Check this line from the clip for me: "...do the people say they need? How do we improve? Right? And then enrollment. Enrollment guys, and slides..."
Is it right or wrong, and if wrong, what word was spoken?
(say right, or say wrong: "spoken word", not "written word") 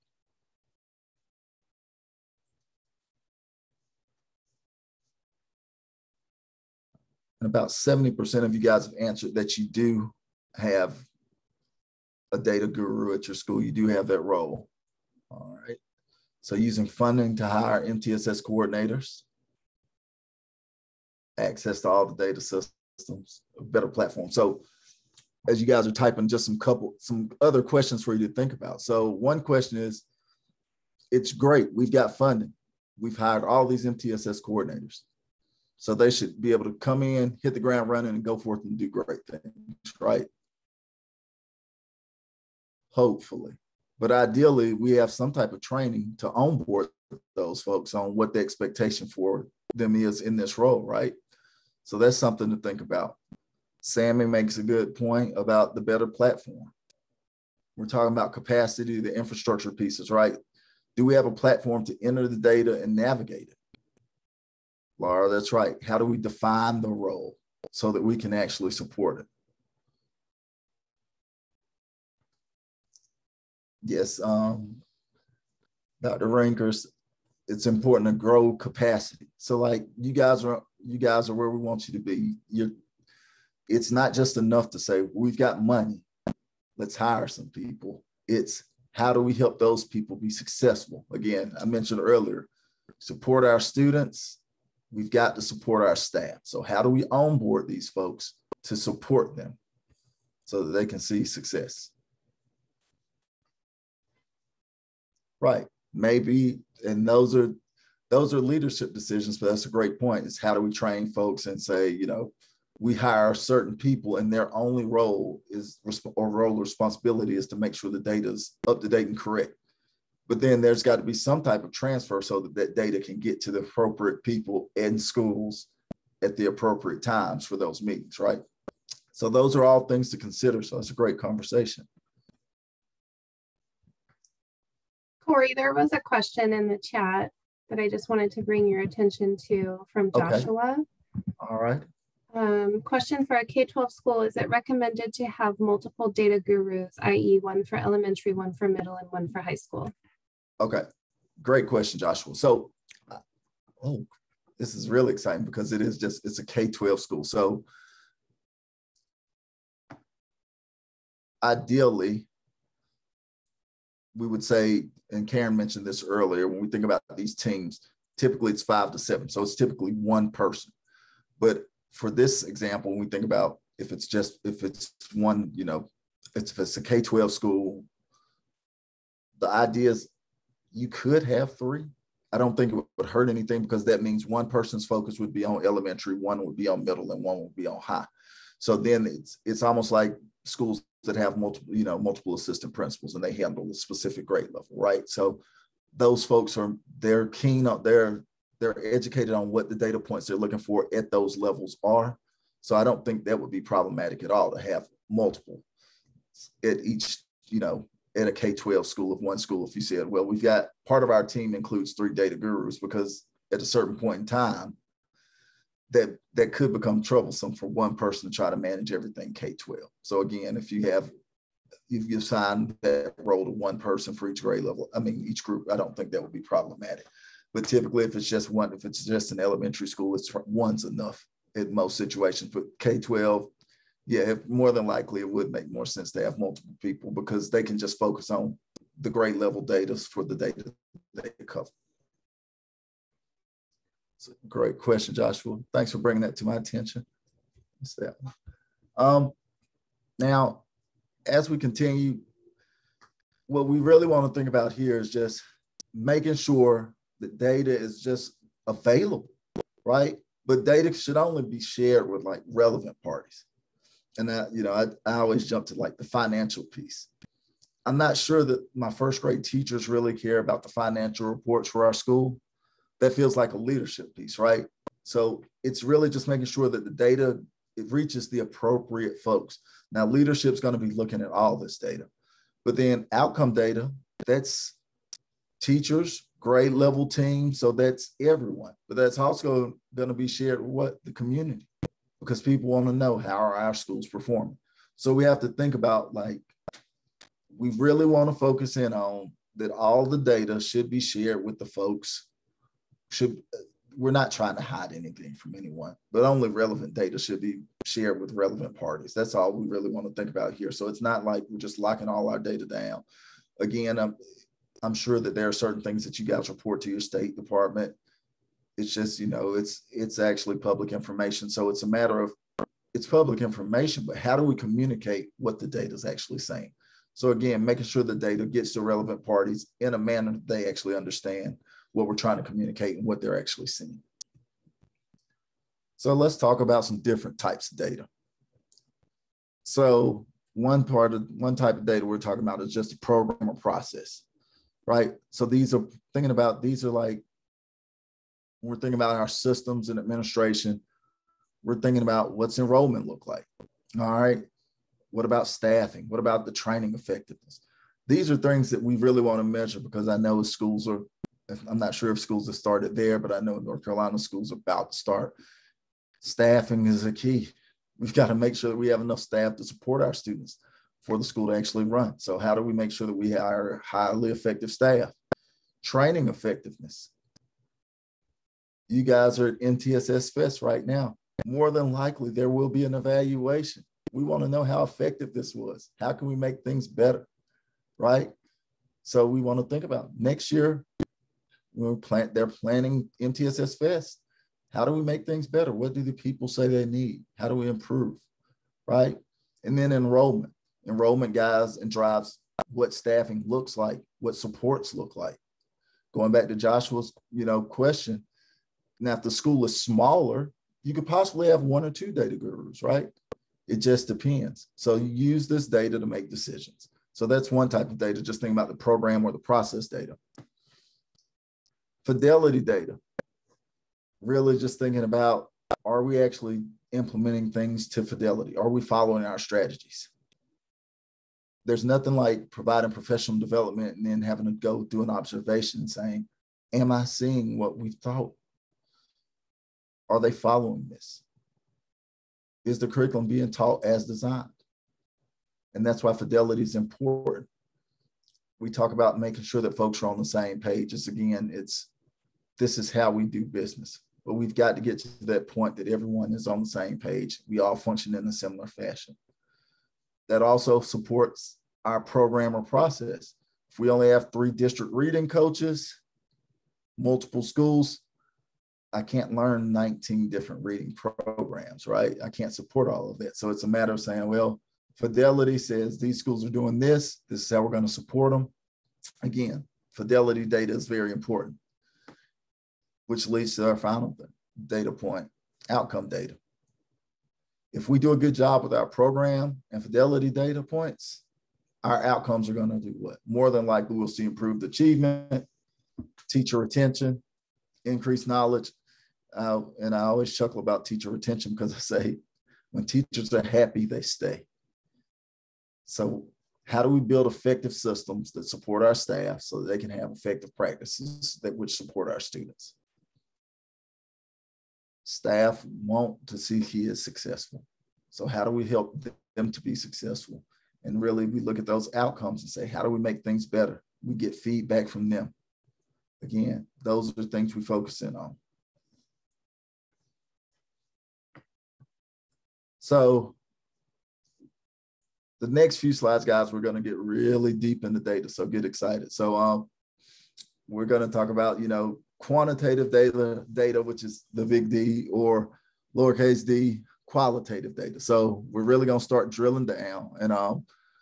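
wrong: "drives", not "slides".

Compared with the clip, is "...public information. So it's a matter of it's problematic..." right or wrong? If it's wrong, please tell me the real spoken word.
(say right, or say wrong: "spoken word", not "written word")
wrong: "public", not "problematic".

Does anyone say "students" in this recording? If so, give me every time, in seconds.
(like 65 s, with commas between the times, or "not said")
93 s, 370 s, 512 s.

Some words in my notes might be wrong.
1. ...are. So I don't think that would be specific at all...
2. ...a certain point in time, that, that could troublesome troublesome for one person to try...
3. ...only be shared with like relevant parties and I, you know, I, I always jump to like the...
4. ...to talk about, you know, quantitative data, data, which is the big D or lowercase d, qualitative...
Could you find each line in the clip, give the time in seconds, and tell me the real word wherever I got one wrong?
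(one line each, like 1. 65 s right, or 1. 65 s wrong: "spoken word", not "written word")
1. 201 s wrong: "problematic", not "specific"
2. 213 s wrong: "become", not "troublesome"
3. 261 s right
4. 541 s right.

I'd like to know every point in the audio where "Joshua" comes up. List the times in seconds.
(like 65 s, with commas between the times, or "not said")
140 s, 151 s, 245 s, 406 s.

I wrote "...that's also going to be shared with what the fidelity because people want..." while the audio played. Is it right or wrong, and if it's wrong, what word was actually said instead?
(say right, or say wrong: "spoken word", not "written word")
wrong: "community", not "fidelity".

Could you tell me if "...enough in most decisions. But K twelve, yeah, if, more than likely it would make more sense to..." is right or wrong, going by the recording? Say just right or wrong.
wrong.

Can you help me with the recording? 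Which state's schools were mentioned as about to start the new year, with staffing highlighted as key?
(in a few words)
North Carolina.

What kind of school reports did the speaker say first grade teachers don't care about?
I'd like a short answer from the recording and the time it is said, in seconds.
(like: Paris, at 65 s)
financial reports, at 270 s.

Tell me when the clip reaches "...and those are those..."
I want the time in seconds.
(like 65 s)
106 s.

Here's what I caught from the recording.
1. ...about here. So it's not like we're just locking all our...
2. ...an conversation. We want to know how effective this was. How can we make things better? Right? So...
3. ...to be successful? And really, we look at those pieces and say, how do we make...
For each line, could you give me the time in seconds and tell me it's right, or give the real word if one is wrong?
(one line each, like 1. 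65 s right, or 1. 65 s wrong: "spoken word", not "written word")
1. 310 s right
2. 382 s wrong: "evaluation", not "conversation"
3. 519 s wrong: "outcomes", not "pieces".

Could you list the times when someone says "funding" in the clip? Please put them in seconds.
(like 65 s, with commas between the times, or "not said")
16 s, 32 s.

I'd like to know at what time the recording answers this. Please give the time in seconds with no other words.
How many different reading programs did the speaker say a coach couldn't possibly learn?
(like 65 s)
469 s.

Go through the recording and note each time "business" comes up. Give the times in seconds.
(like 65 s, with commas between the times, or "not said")
453 s.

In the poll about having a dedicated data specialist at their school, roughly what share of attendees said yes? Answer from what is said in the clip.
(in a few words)
70%.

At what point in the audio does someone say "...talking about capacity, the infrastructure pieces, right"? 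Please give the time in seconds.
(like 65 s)
57 s.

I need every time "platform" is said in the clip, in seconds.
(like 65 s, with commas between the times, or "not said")
23 s, 56 s, 61 s.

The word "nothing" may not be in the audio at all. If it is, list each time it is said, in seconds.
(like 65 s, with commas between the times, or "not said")
431 s.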